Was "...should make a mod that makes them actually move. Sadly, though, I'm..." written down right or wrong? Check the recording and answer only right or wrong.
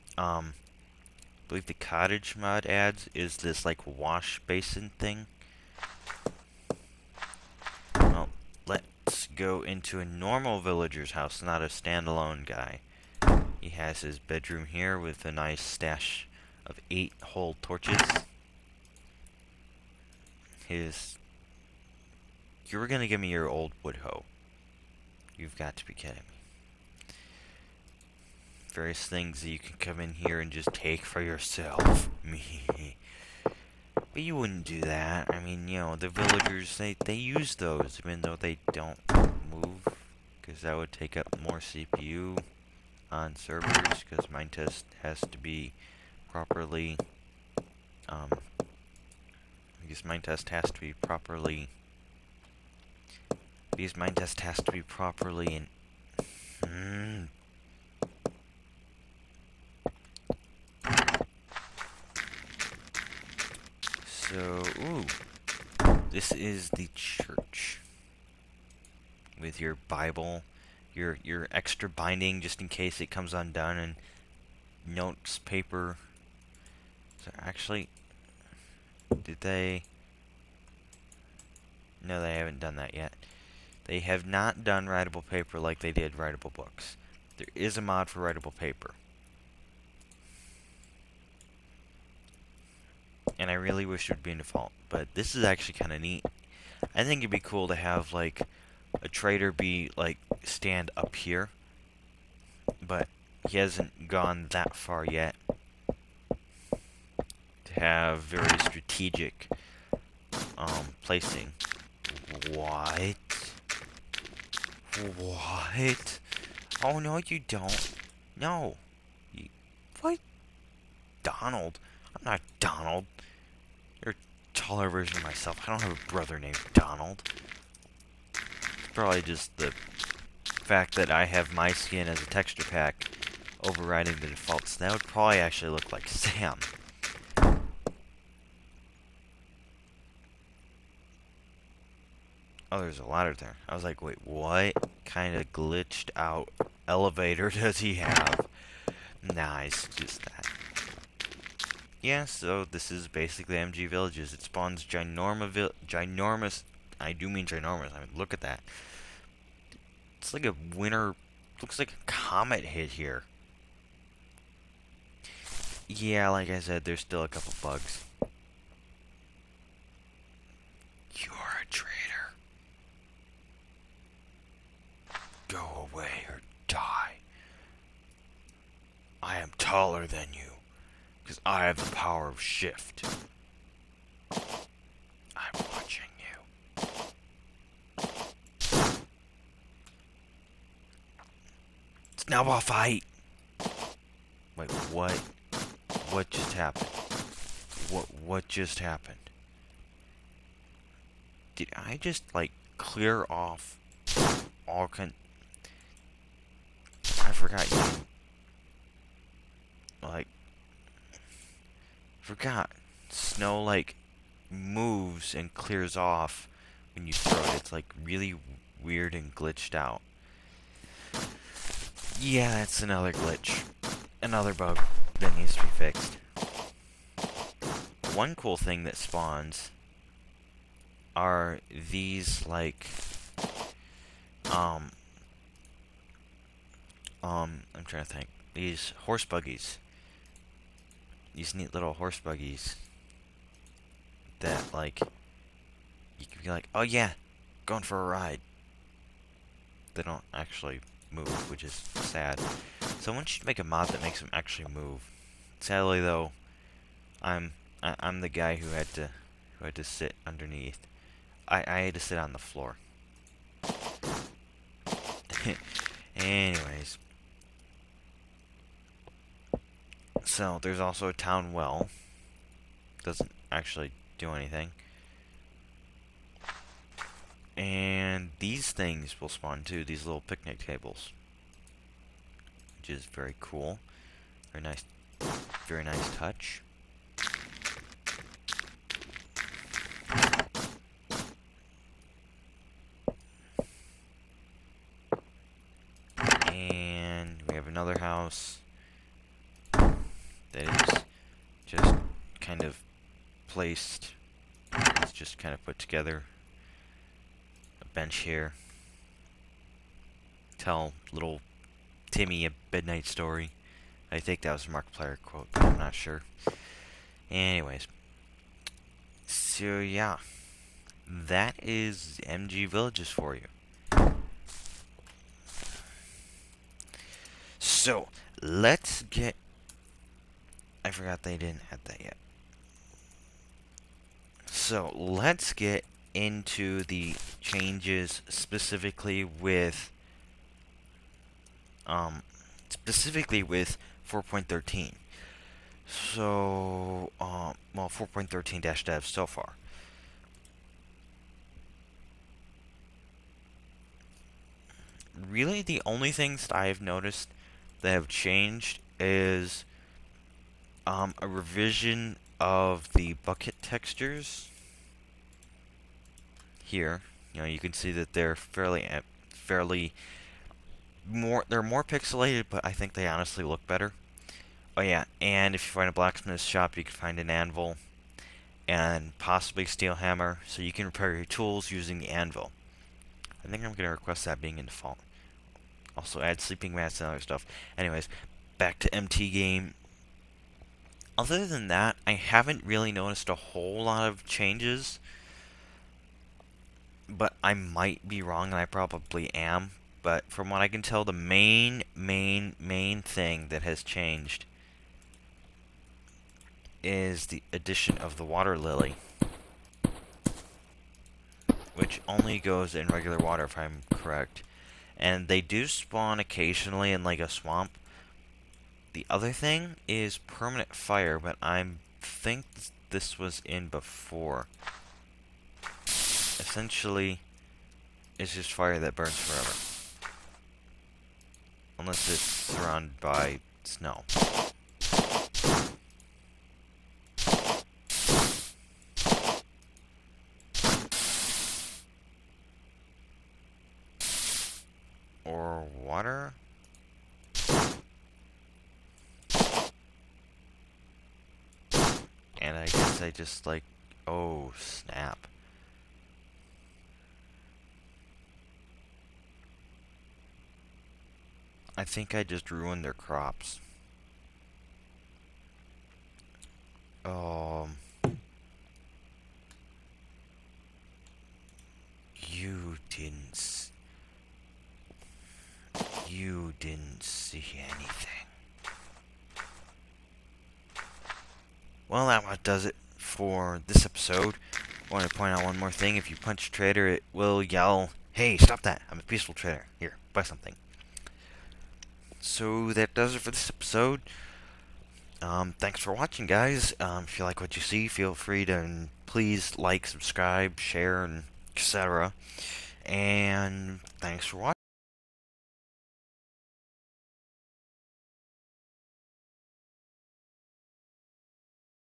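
right.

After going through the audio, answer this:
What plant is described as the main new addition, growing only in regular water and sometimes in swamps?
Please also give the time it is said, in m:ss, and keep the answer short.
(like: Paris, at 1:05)
Water lily, at 6:48.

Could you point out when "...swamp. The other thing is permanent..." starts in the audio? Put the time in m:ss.
6:57.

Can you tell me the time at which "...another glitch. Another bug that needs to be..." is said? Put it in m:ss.
3:42.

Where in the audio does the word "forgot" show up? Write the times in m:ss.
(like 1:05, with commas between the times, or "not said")
3:27, 3:32, 5:30.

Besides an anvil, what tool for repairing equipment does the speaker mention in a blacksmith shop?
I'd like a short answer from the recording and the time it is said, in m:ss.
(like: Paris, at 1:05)
Steel hammer, at 6:19.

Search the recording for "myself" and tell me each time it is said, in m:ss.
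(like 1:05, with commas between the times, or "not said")
2:05.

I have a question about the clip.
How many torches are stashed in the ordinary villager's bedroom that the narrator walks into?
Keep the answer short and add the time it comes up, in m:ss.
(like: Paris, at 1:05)
8, at 0:16.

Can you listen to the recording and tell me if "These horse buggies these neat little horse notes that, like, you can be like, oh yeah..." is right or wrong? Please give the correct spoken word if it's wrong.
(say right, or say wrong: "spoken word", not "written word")
wrong: "buggies", not "notes".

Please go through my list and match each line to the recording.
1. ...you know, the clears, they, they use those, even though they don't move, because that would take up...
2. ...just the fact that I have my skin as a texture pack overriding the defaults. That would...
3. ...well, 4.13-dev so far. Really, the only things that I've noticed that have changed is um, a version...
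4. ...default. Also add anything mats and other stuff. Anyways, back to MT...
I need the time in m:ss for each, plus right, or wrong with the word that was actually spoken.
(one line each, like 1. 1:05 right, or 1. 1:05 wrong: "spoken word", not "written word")
1. 0:35 wrong: "villagers", not "clears"
2. 2:09 right
3. 5:47 wrong: "revision", not "version"
4. 6:24 wrong: "sleeping", not "anything".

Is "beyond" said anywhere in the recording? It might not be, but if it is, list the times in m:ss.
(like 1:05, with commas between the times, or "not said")
not said.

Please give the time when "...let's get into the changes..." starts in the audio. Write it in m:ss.
5:34.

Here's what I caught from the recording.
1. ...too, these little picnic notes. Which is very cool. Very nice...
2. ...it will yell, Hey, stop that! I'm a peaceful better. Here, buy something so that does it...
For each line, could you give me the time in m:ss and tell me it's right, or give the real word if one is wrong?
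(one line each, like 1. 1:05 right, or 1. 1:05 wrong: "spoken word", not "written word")
1. 4:39 wrong: "tables", not "notes"
2. 8:06 wrong: "trader", not "better".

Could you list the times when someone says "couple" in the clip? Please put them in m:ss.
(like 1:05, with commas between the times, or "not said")
2:47.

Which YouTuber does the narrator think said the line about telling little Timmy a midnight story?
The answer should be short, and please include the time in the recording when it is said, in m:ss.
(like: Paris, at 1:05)
Markiplier, at 5:14.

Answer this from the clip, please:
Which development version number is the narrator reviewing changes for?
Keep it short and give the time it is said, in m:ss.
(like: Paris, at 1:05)
4.13, at 5:44.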